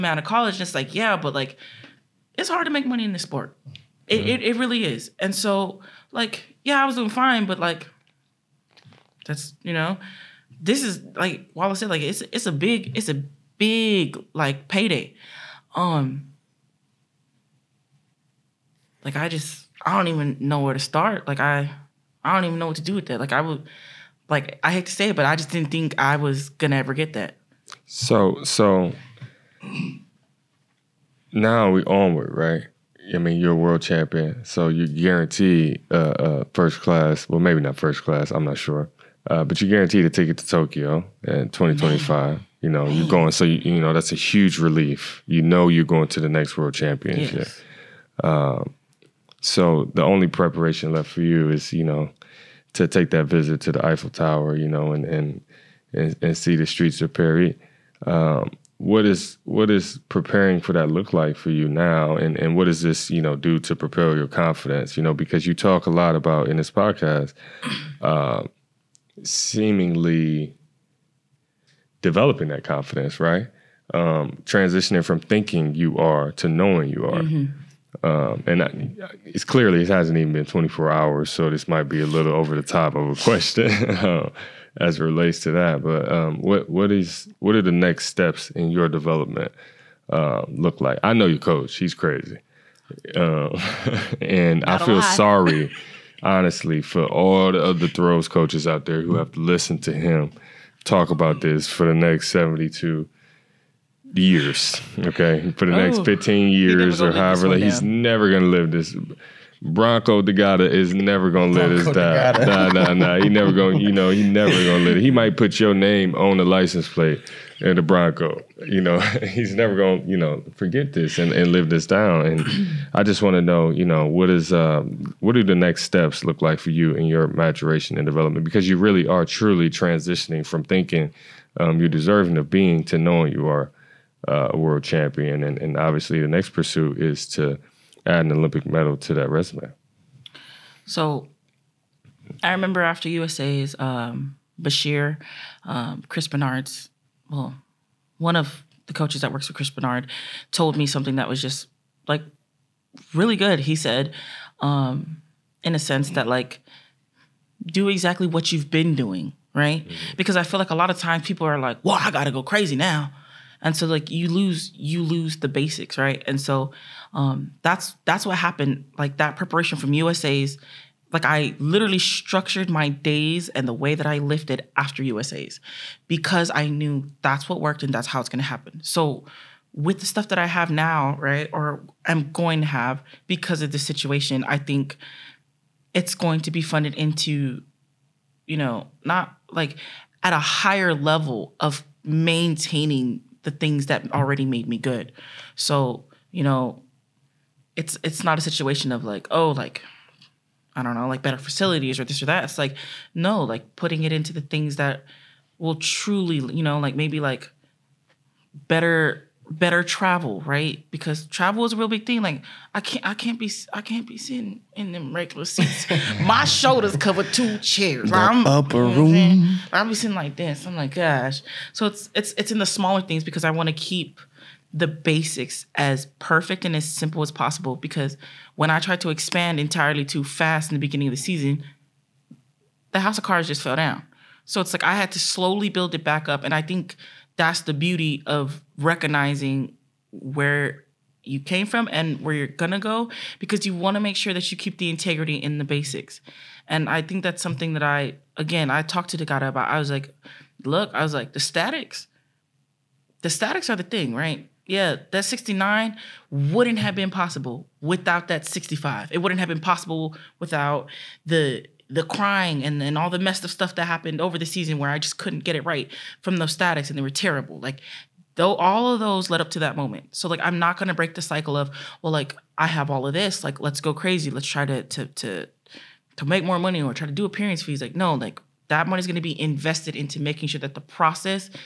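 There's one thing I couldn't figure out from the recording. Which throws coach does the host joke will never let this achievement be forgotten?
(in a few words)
Bronco Degata.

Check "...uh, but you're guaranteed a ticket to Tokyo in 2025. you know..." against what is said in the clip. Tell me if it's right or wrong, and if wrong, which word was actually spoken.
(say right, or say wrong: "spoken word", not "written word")
right.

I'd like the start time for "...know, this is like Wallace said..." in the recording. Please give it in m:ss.
0:09.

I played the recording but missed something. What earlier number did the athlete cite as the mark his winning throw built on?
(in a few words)
65.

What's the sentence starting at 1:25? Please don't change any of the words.
But um, what what is what are the next steps in your development uh, look like?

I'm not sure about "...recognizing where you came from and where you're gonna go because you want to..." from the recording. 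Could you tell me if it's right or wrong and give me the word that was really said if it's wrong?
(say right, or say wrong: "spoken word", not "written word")
right.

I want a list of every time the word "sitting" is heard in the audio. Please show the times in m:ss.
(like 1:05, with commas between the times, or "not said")
3:34, 3:39.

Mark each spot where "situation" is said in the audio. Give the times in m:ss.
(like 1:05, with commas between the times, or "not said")
3:03, 3:18.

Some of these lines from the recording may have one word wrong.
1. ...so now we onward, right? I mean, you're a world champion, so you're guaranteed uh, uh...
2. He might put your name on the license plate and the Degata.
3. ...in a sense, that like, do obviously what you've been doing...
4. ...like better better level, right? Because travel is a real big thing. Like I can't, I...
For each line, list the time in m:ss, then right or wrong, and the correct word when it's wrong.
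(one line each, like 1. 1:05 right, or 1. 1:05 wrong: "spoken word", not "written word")
1. 0:28 right
2. 1:55 wrong: "Bronco", not "Degata"
3. 2:35 wrong: "exactly", not "obviously"
4. 3:27 wrong: "travel", not "level".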